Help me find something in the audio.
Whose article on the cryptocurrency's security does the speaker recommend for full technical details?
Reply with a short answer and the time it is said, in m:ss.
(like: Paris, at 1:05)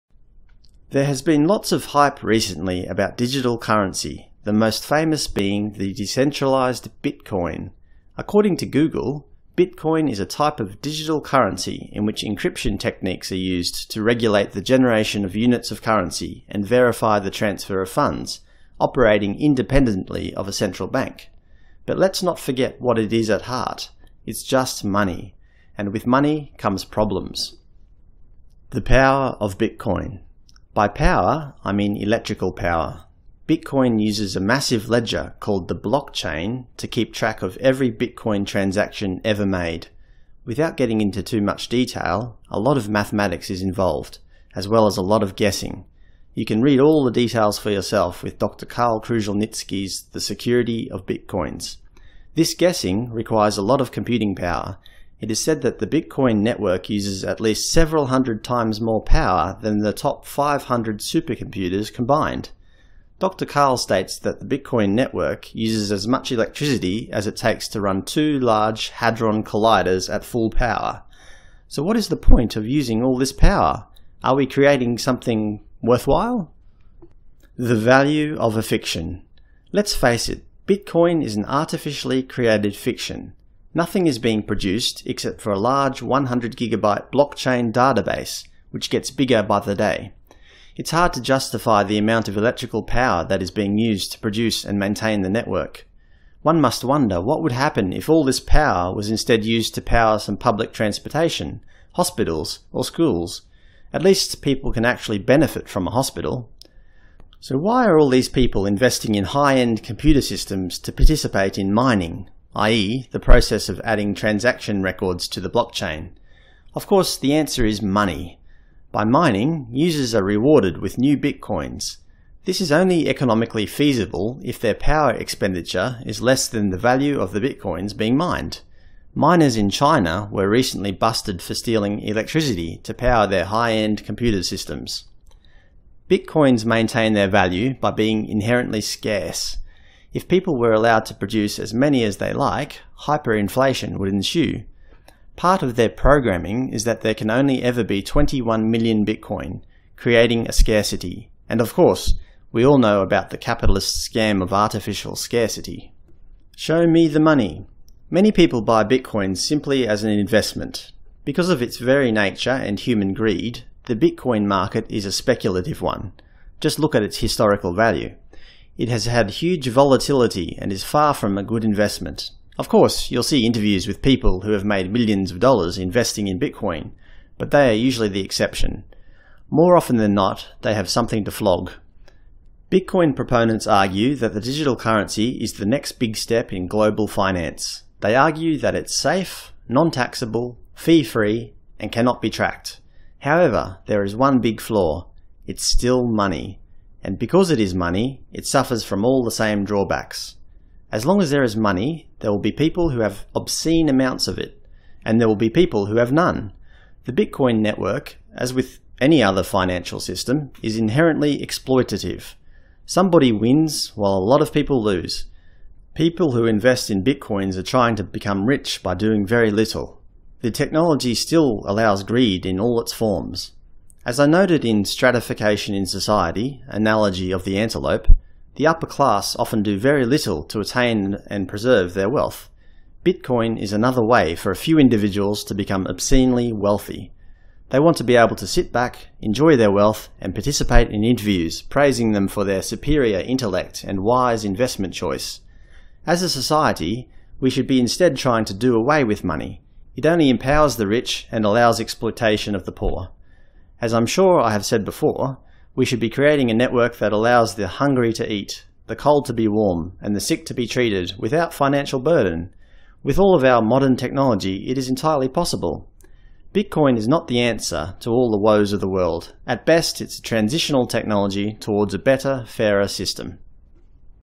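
Dr. Karl Kruszelnicki, at 0:48.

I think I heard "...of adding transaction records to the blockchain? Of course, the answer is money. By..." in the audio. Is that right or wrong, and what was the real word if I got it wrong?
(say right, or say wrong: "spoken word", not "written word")
right.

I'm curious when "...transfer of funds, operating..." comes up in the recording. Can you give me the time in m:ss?
0:17.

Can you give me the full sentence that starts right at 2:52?
Of course, you'll see interviews with people who have made millions of dollars investing in Bitcoin, but they are usually the exception.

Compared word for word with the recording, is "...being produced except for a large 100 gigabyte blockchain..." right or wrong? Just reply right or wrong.
right.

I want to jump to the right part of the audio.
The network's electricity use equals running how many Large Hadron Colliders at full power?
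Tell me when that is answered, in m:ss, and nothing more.
1:08.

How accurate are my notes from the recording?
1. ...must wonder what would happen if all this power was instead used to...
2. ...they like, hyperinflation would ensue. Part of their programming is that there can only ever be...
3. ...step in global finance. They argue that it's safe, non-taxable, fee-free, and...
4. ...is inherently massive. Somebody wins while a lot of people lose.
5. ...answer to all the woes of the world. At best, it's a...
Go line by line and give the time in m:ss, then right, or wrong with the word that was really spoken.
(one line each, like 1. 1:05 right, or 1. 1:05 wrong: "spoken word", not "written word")
1. 1:36 right
2. 2:22 right
3. 3:06 right
4. 3:30 wrong: "exploitative", not "massive"
5. 4:27 right.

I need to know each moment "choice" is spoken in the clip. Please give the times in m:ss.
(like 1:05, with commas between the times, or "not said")
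4:04.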